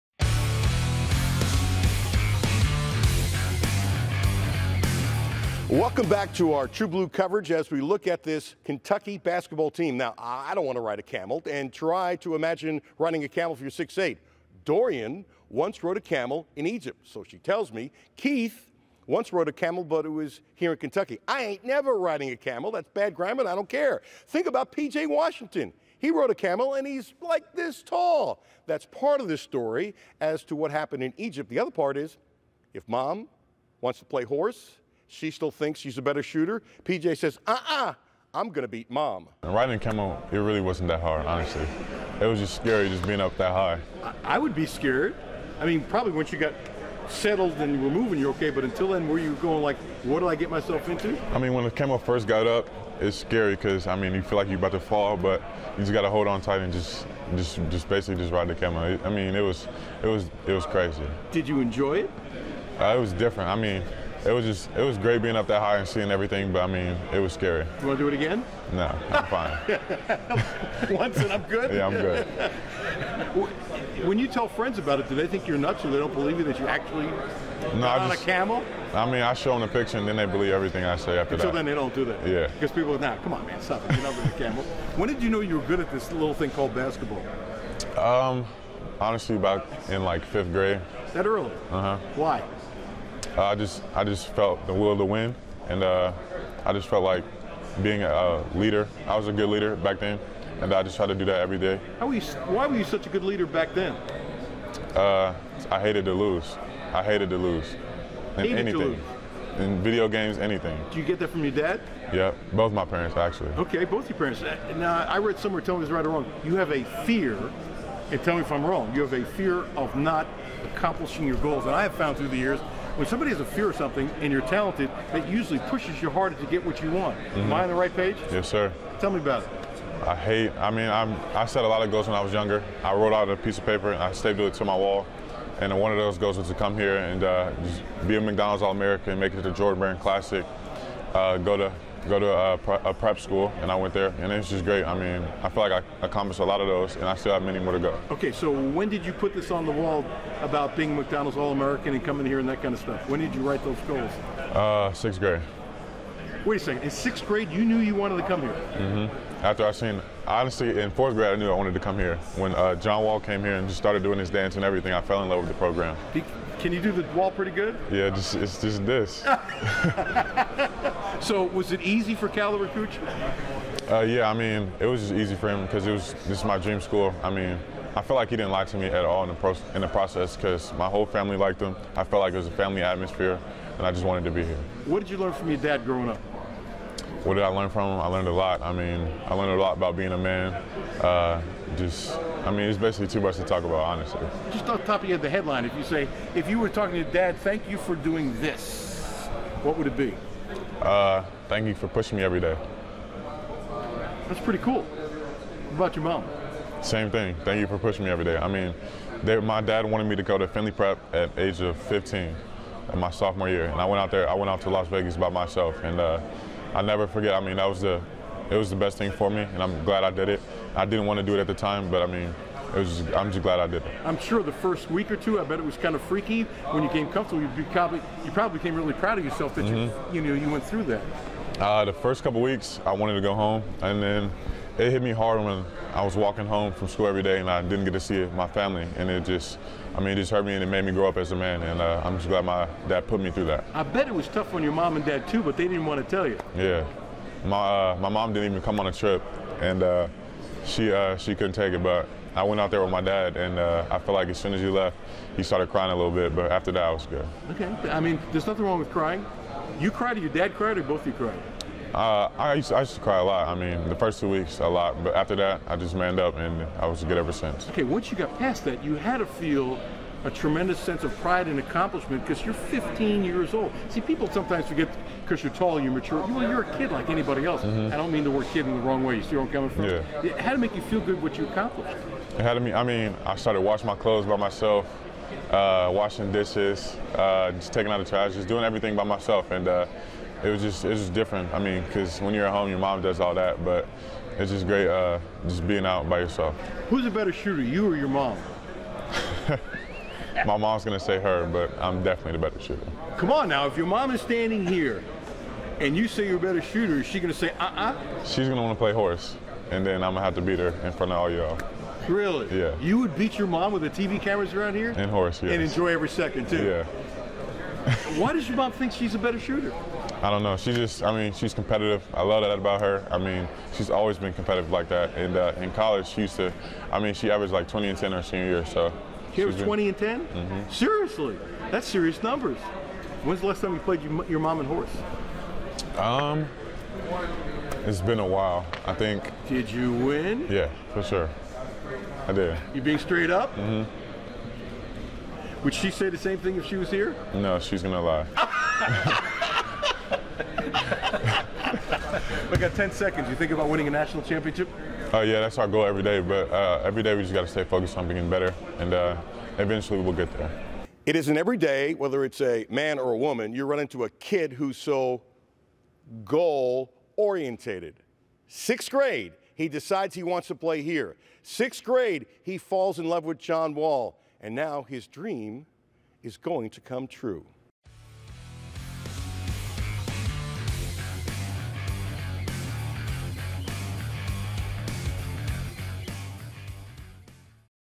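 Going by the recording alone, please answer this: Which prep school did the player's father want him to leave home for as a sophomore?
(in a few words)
Findlay Prep.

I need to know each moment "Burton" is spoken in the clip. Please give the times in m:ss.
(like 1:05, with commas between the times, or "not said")
not said.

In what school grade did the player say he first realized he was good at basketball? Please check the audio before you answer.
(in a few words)
Fifth grade.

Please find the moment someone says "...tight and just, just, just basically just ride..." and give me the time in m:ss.
0:56.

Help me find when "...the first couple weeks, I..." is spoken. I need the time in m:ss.
3:51.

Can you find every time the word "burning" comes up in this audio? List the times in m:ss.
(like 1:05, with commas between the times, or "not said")
not said.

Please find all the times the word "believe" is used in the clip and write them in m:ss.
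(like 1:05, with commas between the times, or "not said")
1:16, 1:20.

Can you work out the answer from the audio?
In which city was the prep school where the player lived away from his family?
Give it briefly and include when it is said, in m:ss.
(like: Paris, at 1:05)
Las Vegas, at 3:34.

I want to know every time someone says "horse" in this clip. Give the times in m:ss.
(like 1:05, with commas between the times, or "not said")
0:34, 5:08, 5:15, 5:34.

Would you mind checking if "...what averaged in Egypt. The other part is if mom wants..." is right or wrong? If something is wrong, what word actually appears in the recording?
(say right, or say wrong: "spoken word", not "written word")
wrong: "happened", not "averaged".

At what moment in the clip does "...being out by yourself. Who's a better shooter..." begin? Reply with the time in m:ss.
4:55.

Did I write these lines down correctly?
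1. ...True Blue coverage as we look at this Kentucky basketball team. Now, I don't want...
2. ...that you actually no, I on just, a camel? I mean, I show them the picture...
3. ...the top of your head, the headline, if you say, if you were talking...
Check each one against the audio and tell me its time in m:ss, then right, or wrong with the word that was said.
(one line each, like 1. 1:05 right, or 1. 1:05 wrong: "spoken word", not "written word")
1. 0:06 right
2. 1:16 right
3. 3:14 right.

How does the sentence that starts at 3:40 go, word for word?
I didn't want to do it at the time, but I mean, it was I'm just glad I did it.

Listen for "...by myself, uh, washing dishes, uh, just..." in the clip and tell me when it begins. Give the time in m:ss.
4:44.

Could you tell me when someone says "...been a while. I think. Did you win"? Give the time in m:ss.
5:38.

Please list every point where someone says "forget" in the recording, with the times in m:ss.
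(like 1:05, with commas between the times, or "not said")
3:37, 4:34.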